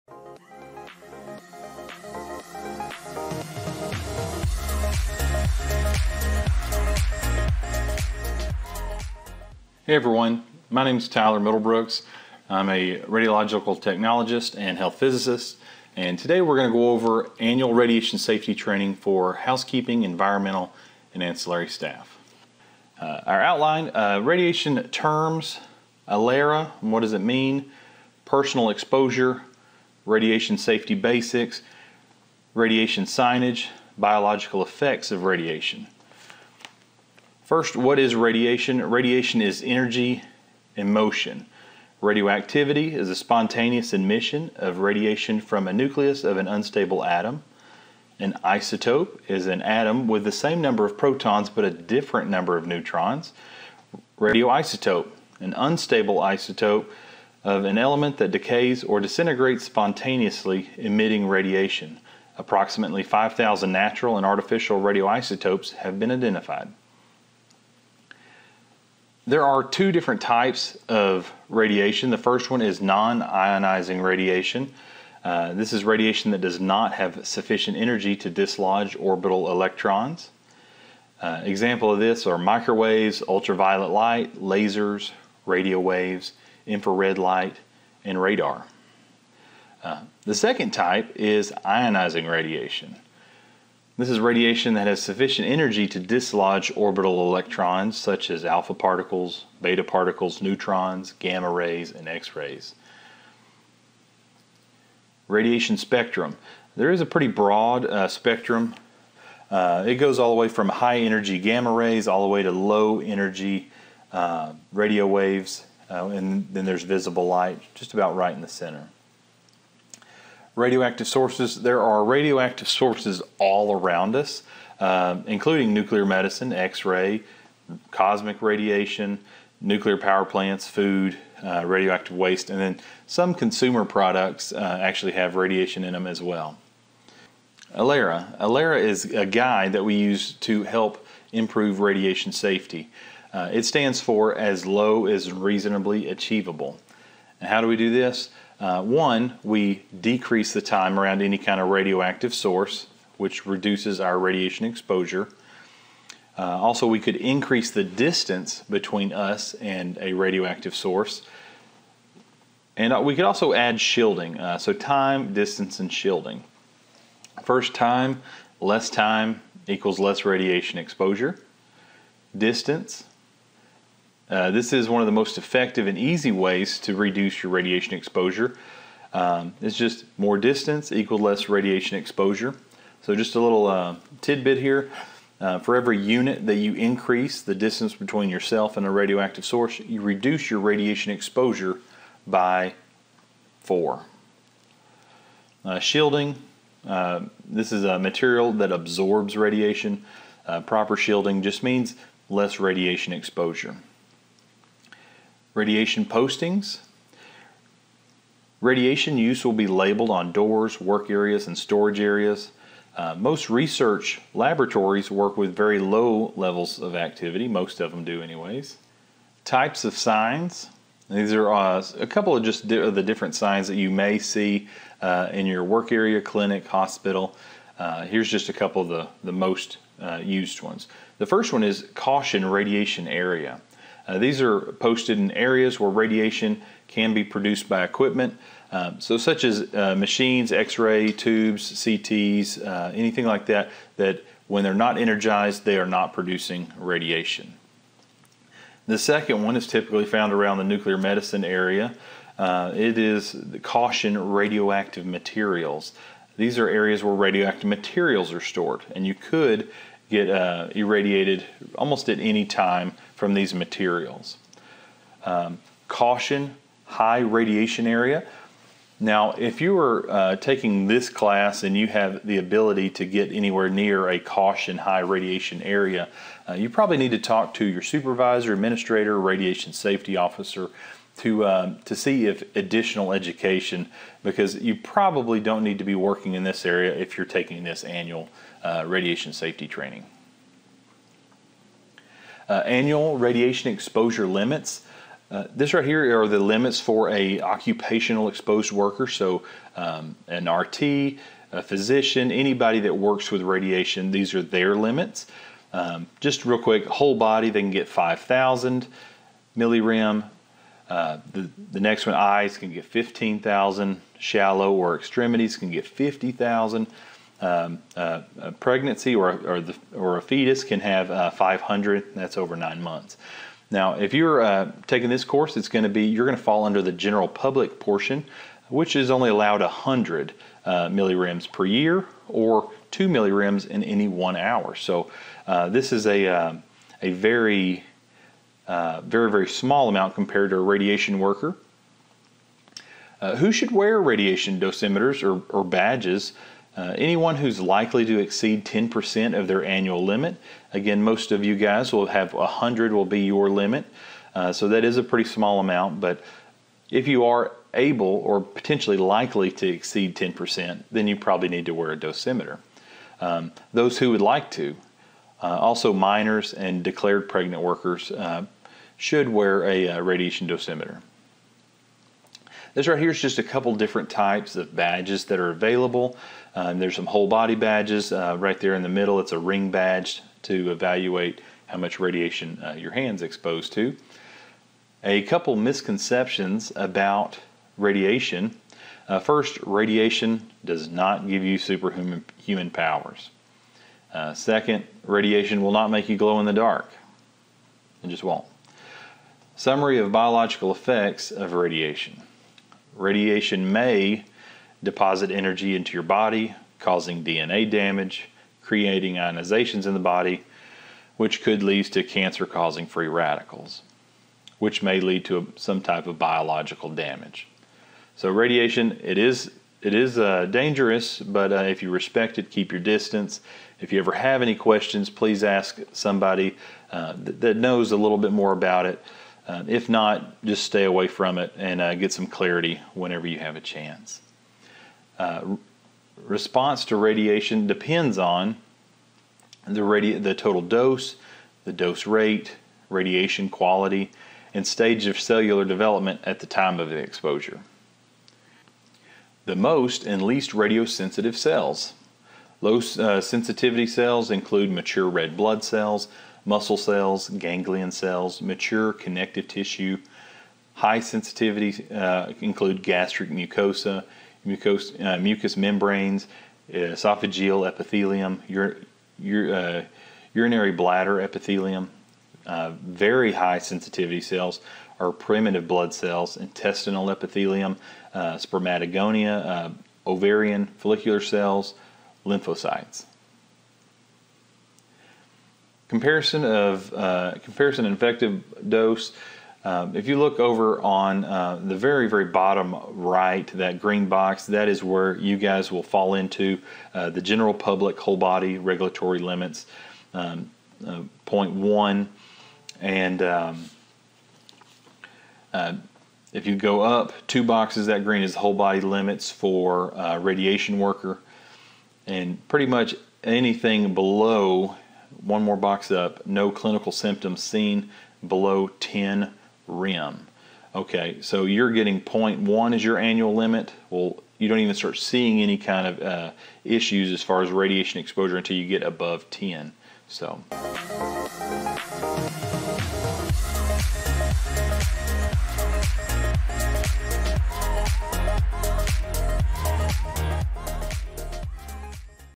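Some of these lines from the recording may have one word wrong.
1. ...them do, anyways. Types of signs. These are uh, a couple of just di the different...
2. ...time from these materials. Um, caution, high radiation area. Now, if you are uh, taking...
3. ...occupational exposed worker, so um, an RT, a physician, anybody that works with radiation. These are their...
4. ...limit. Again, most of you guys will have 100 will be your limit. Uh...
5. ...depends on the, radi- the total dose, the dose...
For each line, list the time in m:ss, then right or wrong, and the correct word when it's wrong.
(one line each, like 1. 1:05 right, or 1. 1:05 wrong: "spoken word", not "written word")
1. 3:37 right
2. 4:22 right
3. 4:57 right
4. 5:50 right
5. 7:17 right.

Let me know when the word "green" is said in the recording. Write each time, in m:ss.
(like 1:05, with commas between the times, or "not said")
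8:13, 8:28.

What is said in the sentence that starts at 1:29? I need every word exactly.
Uh, the second type is ionizing radiation.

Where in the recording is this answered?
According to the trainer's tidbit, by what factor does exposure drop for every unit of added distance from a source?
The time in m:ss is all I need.
3:13.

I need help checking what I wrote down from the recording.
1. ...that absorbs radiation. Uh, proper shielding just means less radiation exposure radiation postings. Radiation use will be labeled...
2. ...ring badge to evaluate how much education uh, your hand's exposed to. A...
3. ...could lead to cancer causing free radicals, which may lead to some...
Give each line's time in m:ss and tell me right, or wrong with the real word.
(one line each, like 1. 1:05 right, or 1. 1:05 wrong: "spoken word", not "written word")
1. 3:18 right
2. 6:19 wrong: "radiation", not "education"
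3. 6:51 right.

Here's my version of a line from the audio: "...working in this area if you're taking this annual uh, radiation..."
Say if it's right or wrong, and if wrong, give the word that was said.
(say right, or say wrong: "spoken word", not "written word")
right.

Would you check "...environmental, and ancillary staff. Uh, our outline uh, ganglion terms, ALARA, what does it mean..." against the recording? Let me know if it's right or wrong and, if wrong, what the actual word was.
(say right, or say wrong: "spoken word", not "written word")
wrong: "radiation", not "ganglion".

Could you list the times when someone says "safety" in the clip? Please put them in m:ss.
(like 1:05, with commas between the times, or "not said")
0:18, 0:30, 2:22, 4:39, 4:49.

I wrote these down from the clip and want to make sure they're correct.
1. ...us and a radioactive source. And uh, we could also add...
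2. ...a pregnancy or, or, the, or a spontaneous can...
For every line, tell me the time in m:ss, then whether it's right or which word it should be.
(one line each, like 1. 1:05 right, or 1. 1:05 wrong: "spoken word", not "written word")
1. 2:39 right
2. 5:18 wrong: "fetus", not "spontaneous".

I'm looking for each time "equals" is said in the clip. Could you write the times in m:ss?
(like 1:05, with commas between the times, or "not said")
2:49, 3:00.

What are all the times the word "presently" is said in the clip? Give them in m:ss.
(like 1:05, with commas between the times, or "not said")
not said.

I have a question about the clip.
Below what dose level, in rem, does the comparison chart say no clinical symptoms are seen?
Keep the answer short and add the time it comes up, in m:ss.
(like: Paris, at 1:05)
10 rem, at 8:38.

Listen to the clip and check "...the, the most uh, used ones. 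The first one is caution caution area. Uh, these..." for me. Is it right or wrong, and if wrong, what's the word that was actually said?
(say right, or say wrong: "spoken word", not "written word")
wrong: "radiation", not "caution".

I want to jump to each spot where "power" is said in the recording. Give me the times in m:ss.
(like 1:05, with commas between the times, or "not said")
2:09, 6:32.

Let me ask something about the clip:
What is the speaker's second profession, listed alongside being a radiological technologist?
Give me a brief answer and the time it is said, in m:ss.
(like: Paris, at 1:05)
health physicist, at 0:14.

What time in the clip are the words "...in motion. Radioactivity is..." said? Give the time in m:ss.
0:40.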